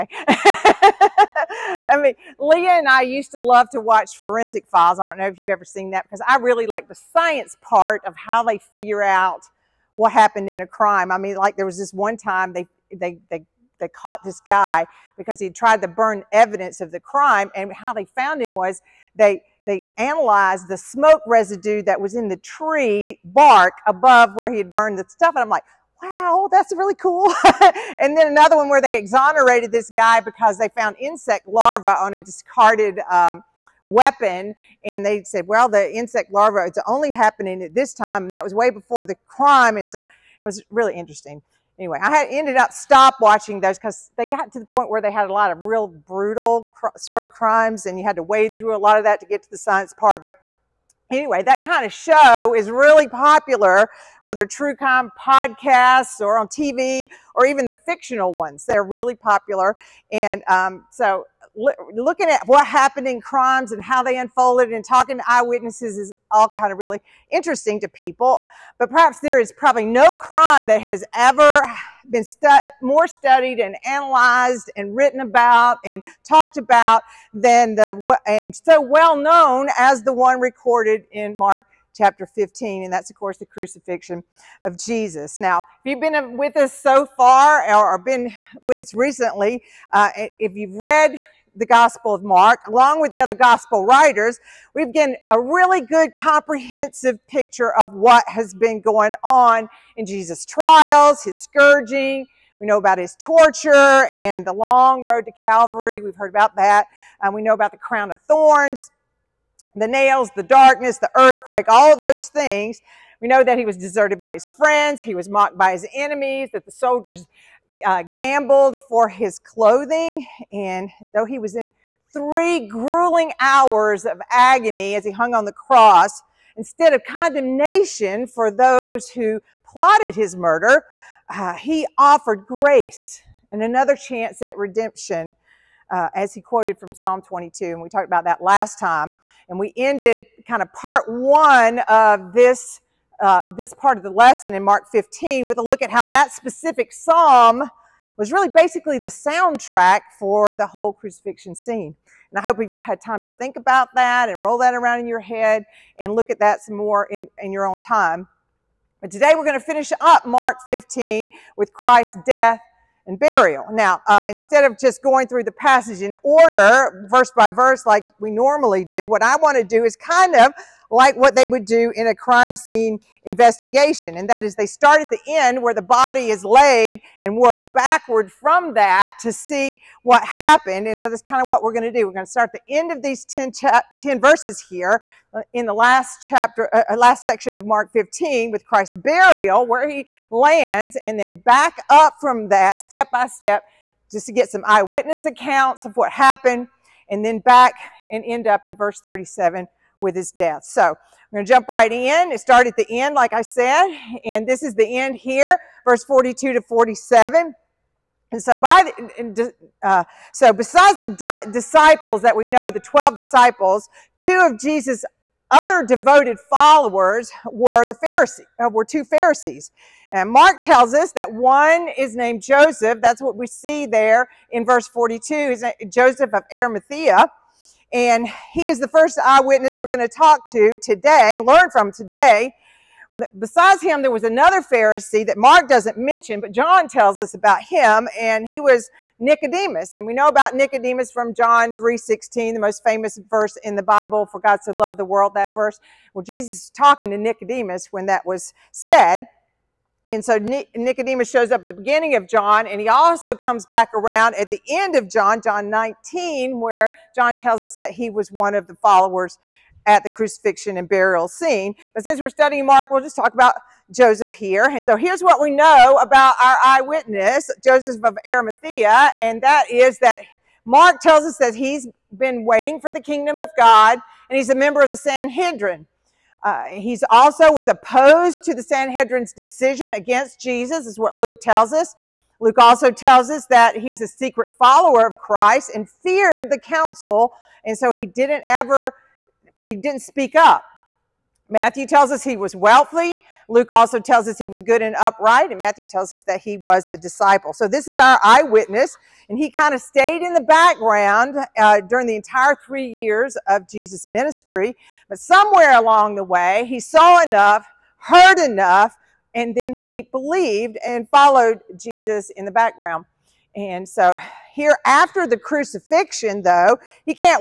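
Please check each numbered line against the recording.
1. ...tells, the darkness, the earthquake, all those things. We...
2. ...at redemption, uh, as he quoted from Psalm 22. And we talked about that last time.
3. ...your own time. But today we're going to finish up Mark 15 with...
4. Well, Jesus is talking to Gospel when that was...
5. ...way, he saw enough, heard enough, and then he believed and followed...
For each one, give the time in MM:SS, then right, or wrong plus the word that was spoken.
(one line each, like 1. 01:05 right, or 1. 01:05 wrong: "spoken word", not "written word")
1. 01:49 wrong: "nails", not "tells"
2. 02:14 right
3. 02:37 right
4. 04:06 wrong: "Nicodemus", not "Gospel"
5. 05:06 right.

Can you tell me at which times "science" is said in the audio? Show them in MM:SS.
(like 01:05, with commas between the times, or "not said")
00:06, 00:49.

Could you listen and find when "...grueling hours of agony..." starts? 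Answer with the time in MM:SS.
02:02.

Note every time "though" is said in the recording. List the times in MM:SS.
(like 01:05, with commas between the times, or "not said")
02:01, 05:16.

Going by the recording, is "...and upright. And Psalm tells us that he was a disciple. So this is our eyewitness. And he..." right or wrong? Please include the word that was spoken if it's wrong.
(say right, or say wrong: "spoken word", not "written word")
wrong: "Matthew", not "Psalm".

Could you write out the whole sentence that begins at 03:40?
And Mark tells us that one is named Joseph.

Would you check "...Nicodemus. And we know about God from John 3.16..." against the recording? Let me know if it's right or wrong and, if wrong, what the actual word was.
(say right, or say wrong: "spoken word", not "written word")
wrong: "Nicodemus", not "God".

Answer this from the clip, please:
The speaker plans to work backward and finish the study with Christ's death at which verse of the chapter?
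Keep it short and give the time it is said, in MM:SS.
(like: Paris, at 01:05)
Verse 37, at 03:18.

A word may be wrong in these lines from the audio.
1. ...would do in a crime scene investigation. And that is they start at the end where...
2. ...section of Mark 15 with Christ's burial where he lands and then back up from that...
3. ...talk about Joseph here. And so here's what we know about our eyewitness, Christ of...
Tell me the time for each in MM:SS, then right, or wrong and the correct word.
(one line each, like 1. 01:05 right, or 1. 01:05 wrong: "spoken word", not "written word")
1. 02:51 right
2. 03:07 right
3. 04:23 wrong: "Joseph", not "Christ".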